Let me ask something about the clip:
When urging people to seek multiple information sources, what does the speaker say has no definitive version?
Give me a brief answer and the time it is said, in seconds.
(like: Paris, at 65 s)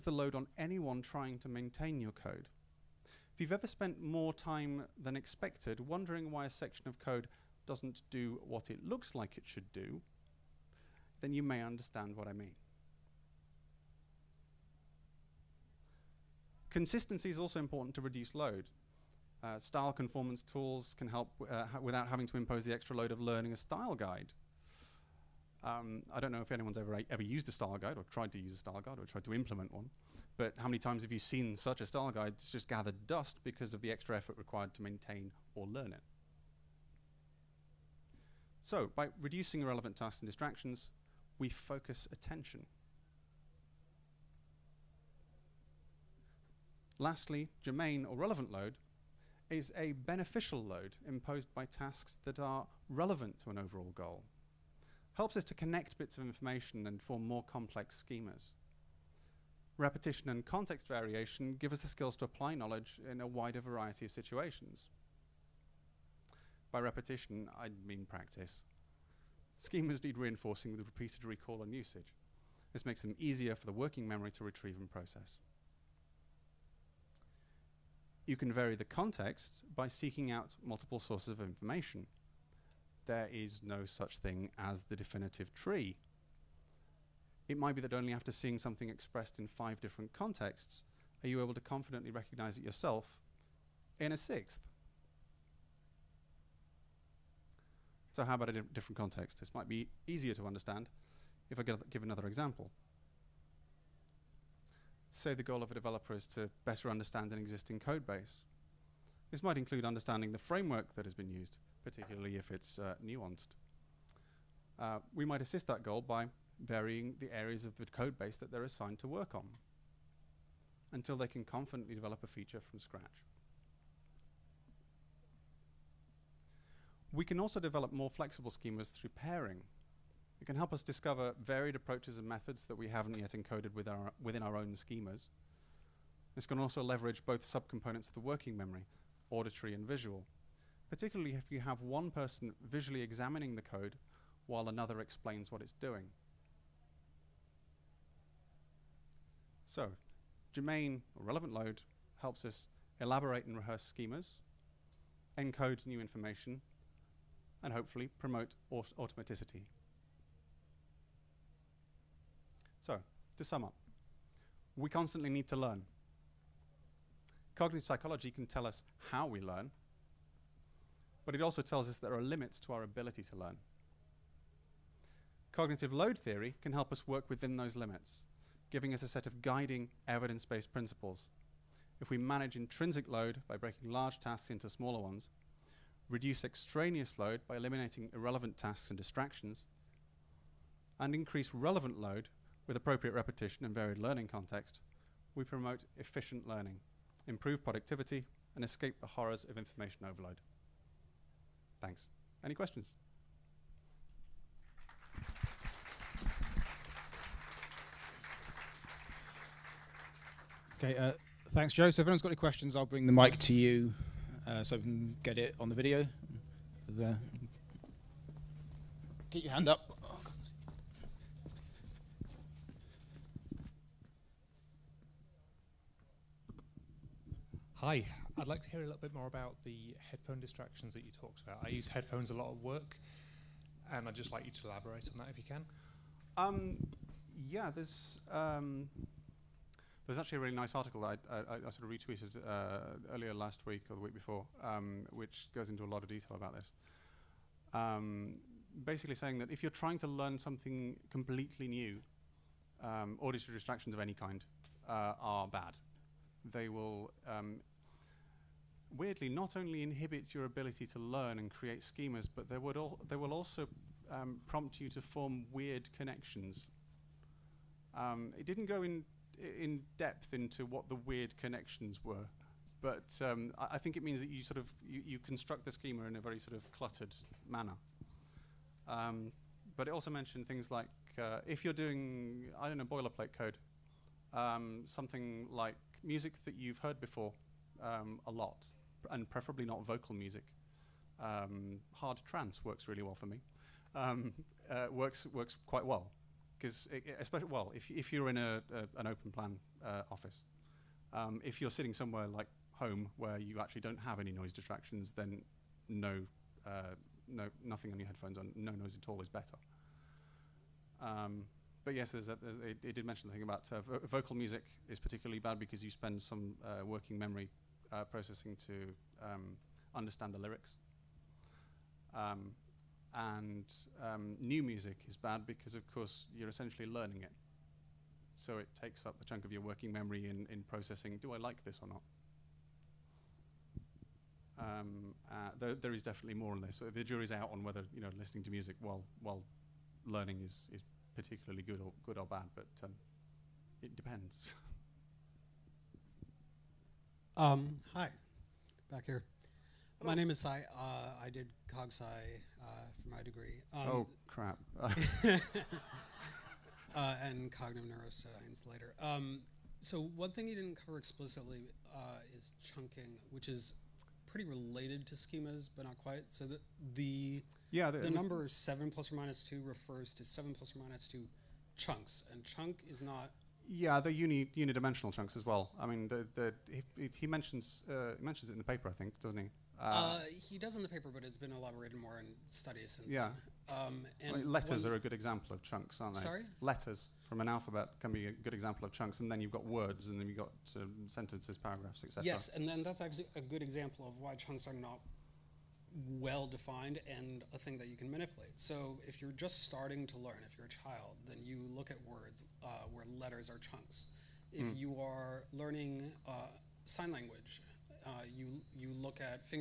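Tree, at 85 s.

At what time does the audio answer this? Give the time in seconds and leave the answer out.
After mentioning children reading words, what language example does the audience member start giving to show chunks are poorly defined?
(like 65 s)
406 s.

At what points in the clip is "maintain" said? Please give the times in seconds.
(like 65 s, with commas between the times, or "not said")
1 s, 34 s.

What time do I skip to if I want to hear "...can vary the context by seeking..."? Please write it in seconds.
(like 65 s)
78 s.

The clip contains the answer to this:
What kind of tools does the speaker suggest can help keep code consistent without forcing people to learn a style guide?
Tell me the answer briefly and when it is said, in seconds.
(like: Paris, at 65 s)
Style conformance tools, at 19 s.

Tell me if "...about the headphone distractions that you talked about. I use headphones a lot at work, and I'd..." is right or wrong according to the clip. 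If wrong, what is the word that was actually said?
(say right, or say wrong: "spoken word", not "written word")
right.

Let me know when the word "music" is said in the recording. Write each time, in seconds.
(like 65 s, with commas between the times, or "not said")
286 s, 290 s, 314 s, 324 s, 338 s.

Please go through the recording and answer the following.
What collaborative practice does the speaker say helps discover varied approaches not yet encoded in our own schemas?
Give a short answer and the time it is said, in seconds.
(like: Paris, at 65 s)
Pairing, at 129 s.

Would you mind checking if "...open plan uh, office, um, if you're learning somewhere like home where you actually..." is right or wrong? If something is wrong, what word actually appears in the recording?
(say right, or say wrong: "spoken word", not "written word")
wrong: "sitting", not "learning".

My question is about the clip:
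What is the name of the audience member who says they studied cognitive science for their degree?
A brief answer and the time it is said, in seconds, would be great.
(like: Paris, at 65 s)
Sai, at 350 s.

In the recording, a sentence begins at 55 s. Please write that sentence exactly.
Helps us to connect bits of information and form more complex schemas.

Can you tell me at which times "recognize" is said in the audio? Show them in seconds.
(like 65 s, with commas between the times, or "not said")
92 s.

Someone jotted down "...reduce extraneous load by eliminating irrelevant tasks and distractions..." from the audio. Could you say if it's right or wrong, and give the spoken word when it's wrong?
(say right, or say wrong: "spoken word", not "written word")
right.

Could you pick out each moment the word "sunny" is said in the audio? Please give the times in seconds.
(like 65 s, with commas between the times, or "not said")
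not said.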